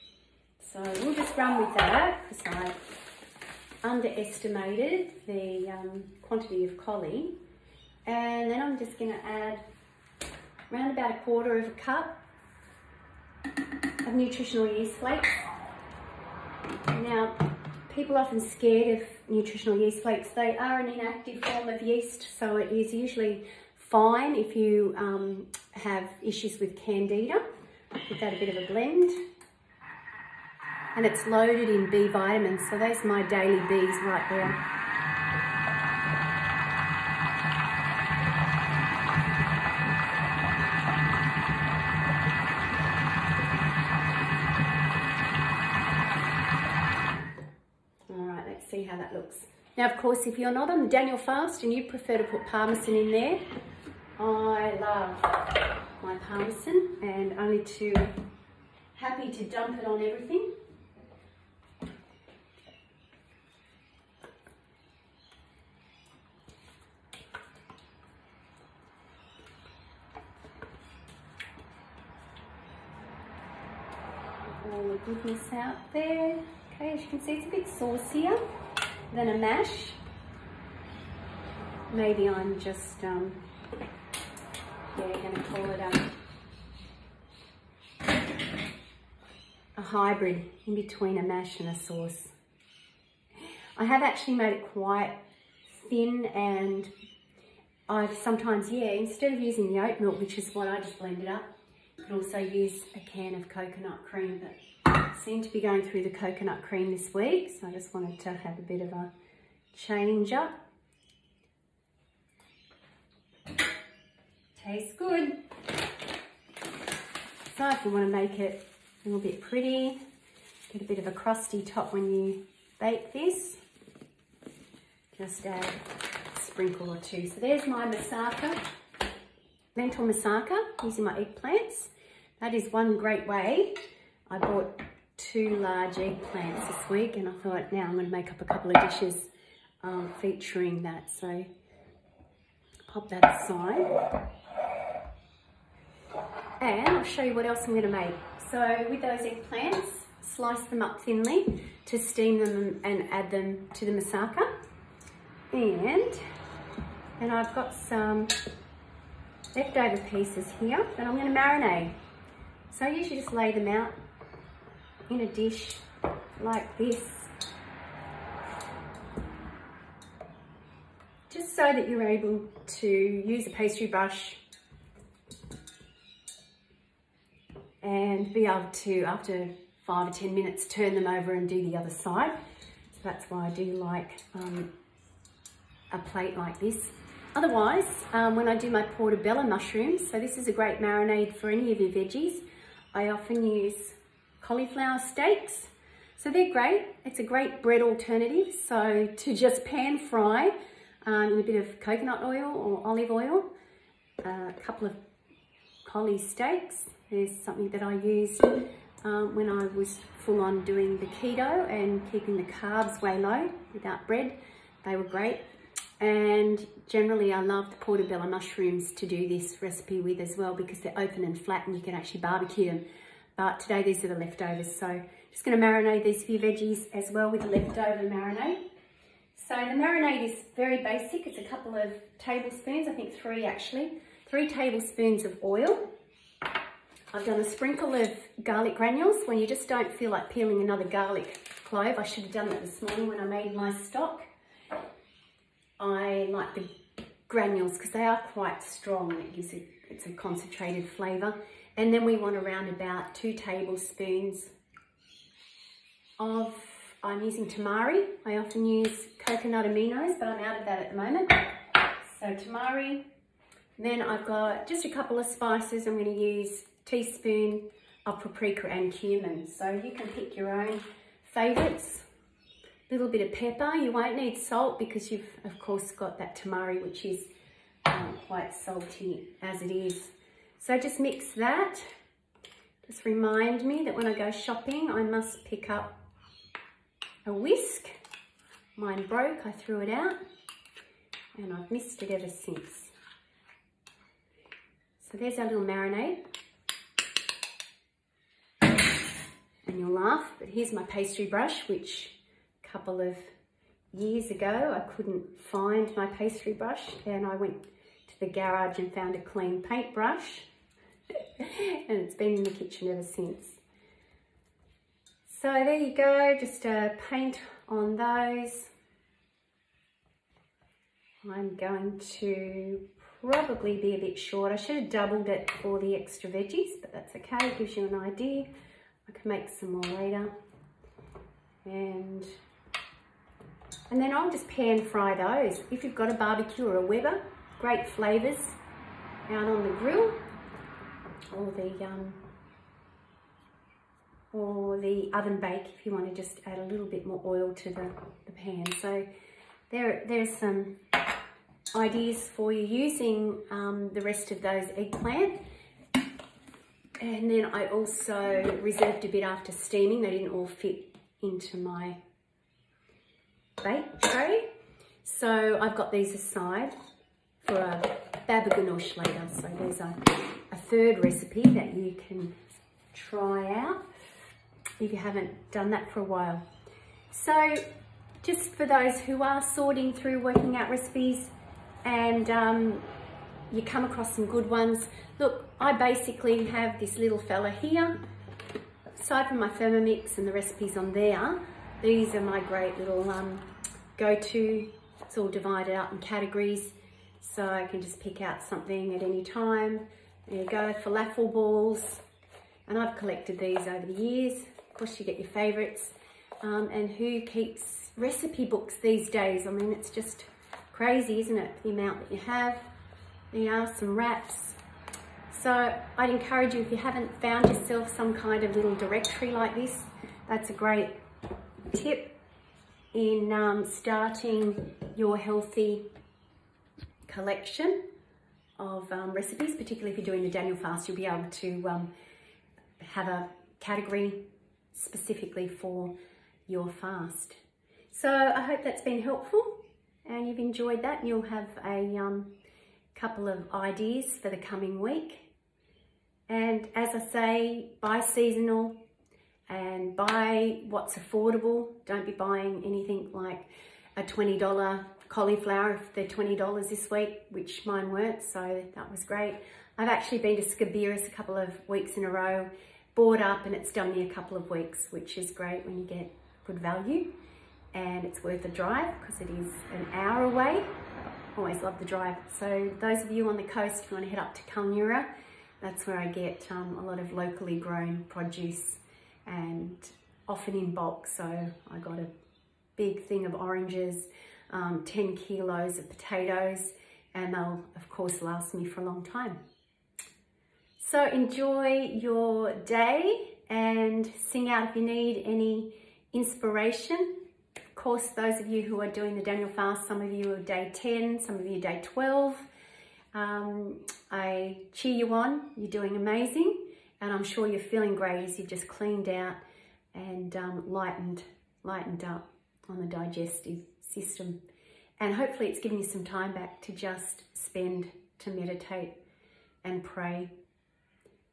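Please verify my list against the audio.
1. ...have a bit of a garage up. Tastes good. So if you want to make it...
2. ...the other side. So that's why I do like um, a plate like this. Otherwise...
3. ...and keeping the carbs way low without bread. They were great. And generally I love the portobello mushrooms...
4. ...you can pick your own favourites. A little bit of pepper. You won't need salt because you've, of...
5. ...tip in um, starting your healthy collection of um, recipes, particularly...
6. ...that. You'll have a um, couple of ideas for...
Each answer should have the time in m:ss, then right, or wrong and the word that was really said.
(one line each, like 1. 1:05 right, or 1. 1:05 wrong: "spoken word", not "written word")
1. 1:48 wrong: "change", not "garage"
2. 3:01 right
3. 3:31 right
4. 4:29 right
5. 7:01 right
6. 7:20 right.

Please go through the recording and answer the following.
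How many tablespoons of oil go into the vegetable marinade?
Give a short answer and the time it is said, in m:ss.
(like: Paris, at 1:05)
3, at 3:54.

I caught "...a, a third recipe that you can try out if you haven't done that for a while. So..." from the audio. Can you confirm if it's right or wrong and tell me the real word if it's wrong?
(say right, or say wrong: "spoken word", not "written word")
right.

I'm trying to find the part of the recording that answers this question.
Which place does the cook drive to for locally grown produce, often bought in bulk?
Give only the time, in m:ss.
7:54.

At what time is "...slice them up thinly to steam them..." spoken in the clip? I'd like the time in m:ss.
2:30.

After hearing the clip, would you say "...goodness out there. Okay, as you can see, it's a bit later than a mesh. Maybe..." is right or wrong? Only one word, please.
wrong.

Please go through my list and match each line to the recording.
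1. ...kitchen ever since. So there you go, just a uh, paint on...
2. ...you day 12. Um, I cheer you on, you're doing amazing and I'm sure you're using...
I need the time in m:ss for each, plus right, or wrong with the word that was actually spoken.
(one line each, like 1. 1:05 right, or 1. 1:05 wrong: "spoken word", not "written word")
1. 5:12 right
2. 8:21 wrong: "feeling", not "using".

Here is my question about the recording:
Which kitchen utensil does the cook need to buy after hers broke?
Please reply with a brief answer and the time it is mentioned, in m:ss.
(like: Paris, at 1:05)
a whisk, at 4:47.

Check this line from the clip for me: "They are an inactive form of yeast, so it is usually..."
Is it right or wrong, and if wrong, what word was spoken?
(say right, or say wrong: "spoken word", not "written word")
right.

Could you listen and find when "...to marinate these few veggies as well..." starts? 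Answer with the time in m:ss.
3:45.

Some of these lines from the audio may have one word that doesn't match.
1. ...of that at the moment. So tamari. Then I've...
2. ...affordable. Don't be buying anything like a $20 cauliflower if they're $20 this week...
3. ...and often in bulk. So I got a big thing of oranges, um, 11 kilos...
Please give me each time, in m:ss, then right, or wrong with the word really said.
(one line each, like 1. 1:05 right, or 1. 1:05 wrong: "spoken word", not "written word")
1. 4:20 right
2. 7:30 right
3. 7:59 wrong: "10", not "11".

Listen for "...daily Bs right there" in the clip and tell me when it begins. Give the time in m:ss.
0:33.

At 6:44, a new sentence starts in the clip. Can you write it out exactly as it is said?
Of course, you get your favorites.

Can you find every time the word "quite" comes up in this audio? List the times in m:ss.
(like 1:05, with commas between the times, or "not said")
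1:34, 4:08, 4:38.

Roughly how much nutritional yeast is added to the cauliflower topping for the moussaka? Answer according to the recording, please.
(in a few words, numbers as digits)
a quarter of a cup.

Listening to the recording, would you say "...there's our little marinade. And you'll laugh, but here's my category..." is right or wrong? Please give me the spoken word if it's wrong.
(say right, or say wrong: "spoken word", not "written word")
wrong: "pastry", not "category".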